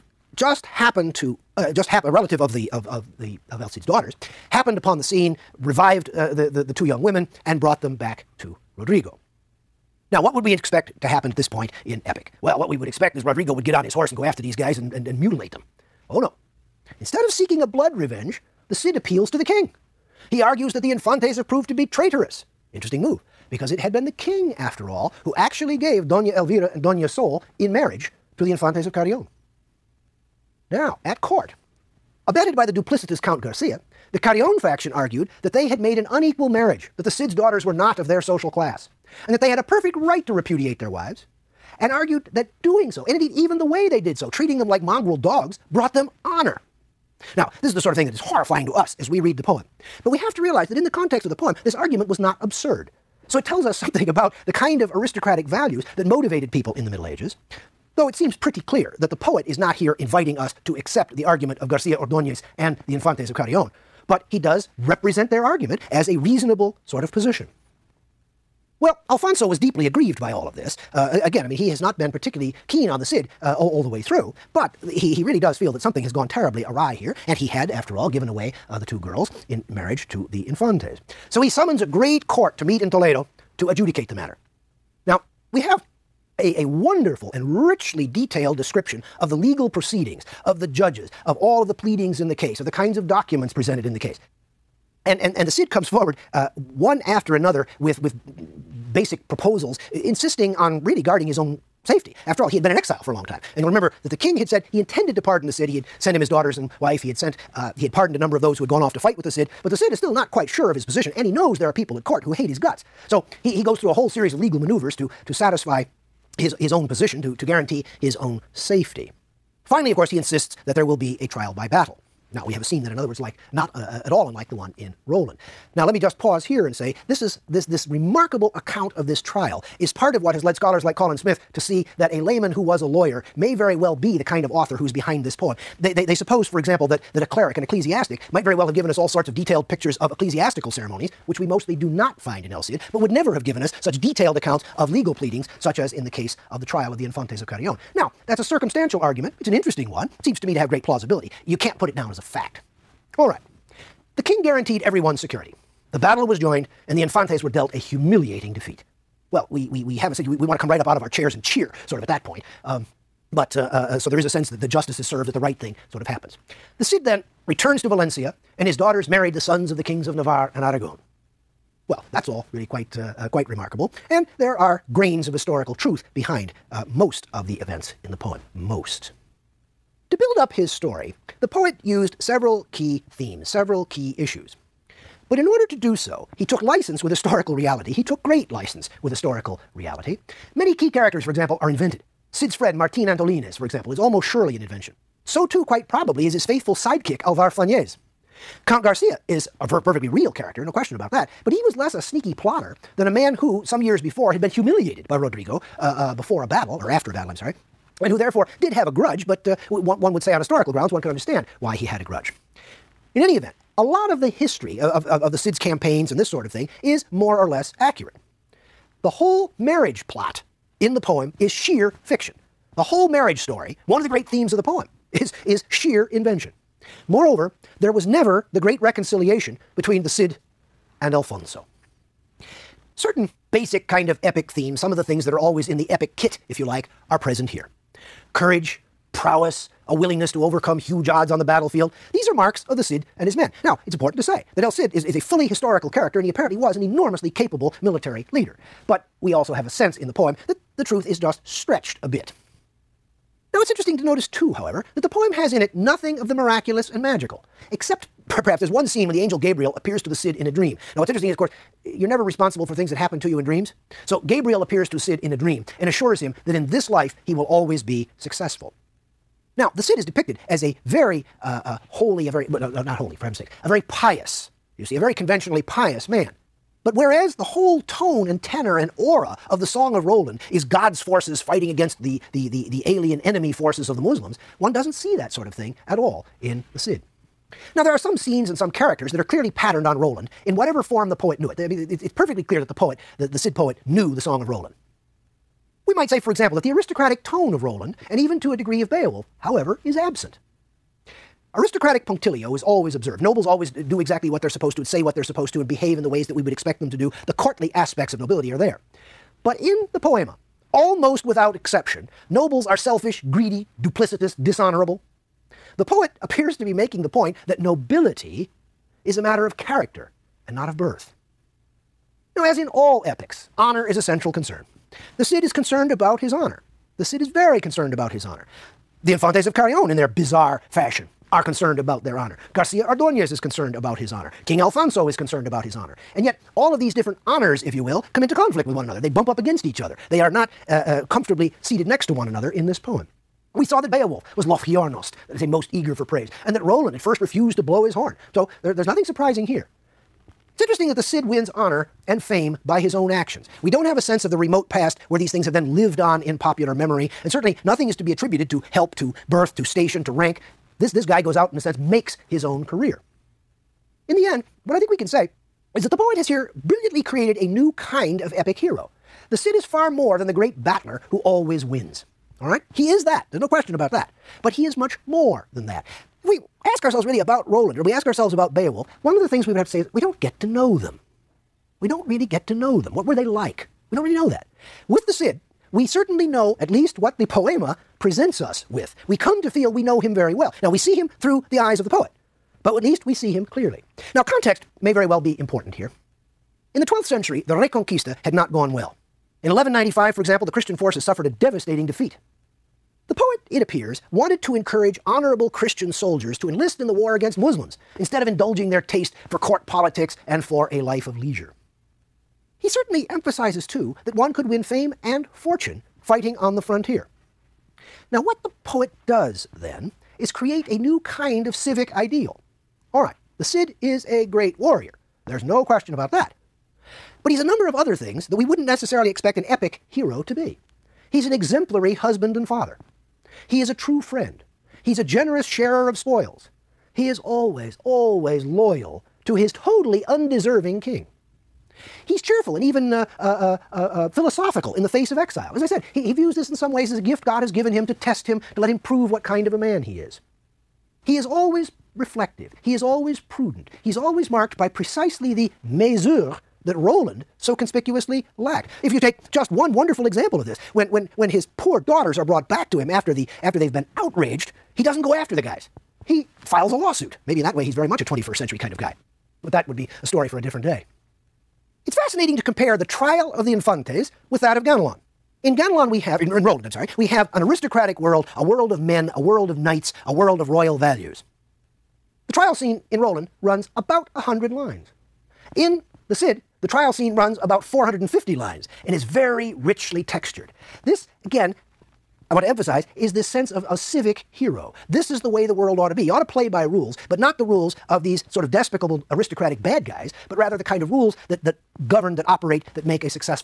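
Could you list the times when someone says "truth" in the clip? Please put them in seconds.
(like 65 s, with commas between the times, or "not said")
175 s, 250 s.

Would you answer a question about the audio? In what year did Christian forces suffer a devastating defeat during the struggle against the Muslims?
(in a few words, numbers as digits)
1195.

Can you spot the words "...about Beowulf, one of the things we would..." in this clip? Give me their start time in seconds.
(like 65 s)
378 s.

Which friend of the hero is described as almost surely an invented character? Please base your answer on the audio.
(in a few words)
Martin Antolines.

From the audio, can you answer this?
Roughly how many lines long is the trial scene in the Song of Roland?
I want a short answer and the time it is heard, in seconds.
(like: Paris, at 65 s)
100, at 484 s.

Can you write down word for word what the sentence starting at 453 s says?
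He's always marked by precisely the mesure that Roland so conspicuously lacked.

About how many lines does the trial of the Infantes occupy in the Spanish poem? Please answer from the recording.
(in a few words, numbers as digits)
450.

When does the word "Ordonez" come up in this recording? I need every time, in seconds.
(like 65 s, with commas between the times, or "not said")
61 s, 332 s.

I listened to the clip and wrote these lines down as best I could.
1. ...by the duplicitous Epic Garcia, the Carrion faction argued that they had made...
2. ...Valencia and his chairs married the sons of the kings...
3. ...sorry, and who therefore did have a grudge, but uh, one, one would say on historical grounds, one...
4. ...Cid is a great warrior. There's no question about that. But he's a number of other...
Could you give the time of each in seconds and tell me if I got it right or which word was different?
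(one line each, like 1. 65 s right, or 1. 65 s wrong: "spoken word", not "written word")
1. 32 s wrong: "Count", not "Epic"
2. 167 s wrong: "daughters", not "chairs"
3. 207 s right
4. 423 s right.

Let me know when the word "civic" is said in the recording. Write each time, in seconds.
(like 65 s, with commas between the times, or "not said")
421 s, 493 s.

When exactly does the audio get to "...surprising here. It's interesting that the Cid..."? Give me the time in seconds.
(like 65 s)
349 s.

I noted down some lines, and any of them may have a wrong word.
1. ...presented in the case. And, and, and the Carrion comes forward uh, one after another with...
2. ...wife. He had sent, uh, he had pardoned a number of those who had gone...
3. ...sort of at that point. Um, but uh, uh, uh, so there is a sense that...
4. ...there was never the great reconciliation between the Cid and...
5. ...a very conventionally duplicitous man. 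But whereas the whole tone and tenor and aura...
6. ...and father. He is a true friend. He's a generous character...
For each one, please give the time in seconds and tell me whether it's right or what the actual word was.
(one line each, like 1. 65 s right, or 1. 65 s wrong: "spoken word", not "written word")
1. 93 s wrong: "Cid", not "Carrion"
2. 106 s right
3. 161 s right
4. 227 s right
5. 274 s wrong: "pious", not "duplicitous"
6. 432 s wrong: "sharer", not "character".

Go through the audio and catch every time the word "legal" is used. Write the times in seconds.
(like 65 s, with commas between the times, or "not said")
89 s, 114 s, 144 s.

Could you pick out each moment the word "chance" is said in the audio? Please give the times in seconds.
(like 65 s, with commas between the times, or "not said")
not said.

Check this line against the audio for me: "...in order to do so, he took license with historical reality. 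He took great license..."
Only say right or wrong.
right.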